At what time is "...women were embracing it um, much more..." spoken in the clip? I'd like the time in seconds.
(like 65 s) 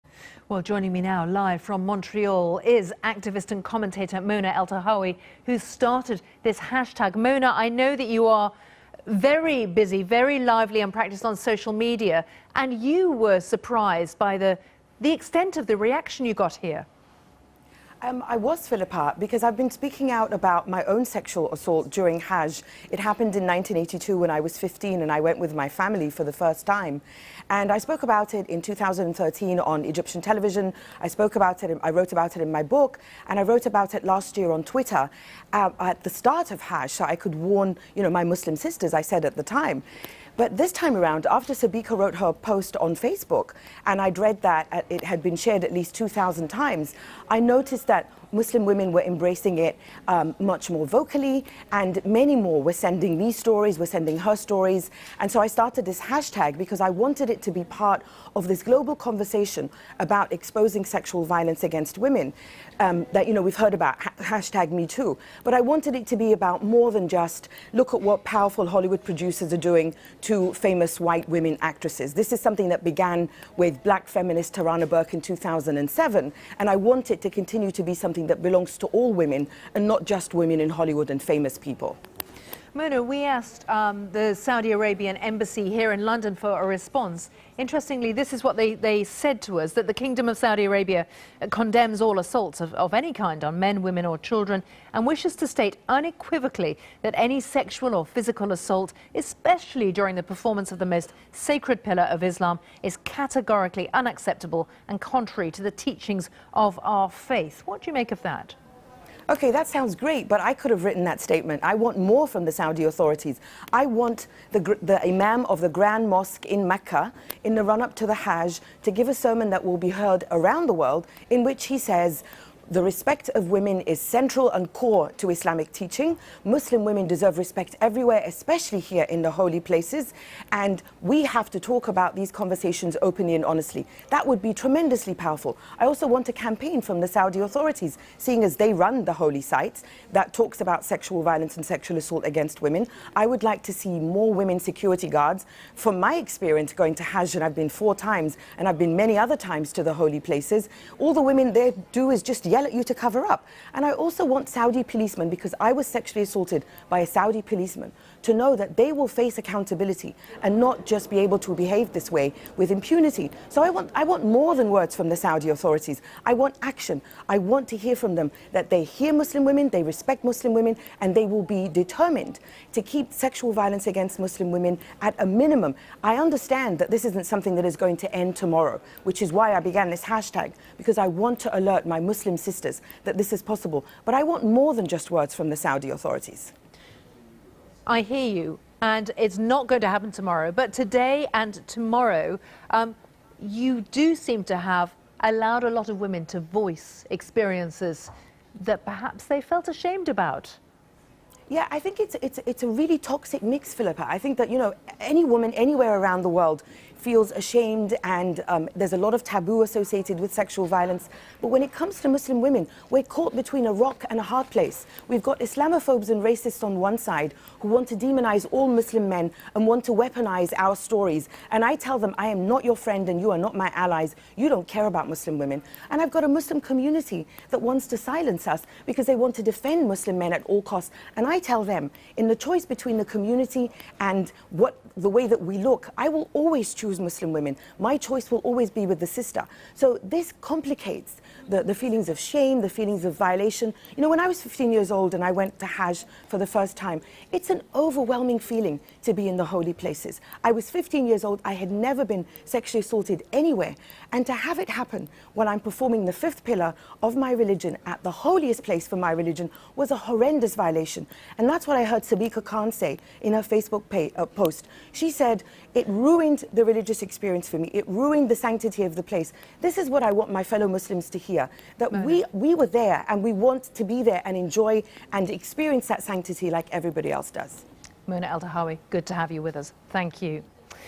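48 s.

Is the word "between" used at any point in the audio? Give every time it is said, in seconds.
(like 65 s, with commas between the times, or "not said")
213 s, 232 s.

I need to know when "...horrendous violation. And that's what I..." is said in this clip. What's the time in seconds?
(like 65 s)
259 s.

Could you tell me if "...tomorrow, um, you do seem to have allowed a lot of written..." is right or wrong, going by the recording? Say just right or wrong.
wrong.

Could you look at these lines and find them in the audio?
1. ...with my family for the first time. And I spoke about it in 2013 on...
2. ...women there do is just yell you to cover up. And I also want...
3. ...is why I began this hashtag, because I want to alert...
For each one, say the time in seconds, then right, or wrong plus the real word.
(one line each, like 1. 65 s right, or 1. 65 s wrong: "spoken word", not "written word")
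1. 25 s right
2. 151 s right
3. 179 s right.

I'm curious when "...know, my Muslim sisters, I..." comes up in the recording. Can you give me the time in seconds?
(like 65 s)
38 s.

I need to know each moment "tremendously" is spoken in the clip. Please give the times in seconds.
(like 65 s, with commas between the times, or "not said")
134 s.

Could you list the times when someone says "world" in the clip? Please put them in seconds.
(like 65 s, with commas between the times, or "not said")
120 s, 206 s.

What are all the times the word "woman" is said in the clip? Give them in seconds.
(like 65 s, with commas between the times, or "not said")
205 s.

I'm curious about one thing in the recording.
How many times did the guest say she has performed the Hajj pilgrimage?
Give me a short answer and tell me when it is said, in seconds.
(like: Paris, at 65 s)
4, at 147 s.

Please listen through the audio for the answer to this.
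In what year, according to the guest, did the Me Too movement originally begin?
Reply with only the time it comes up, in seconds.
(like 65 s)
75 s.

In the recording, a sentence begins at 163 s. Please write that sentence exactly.
So I want, I want more than words from the Saudi authorities.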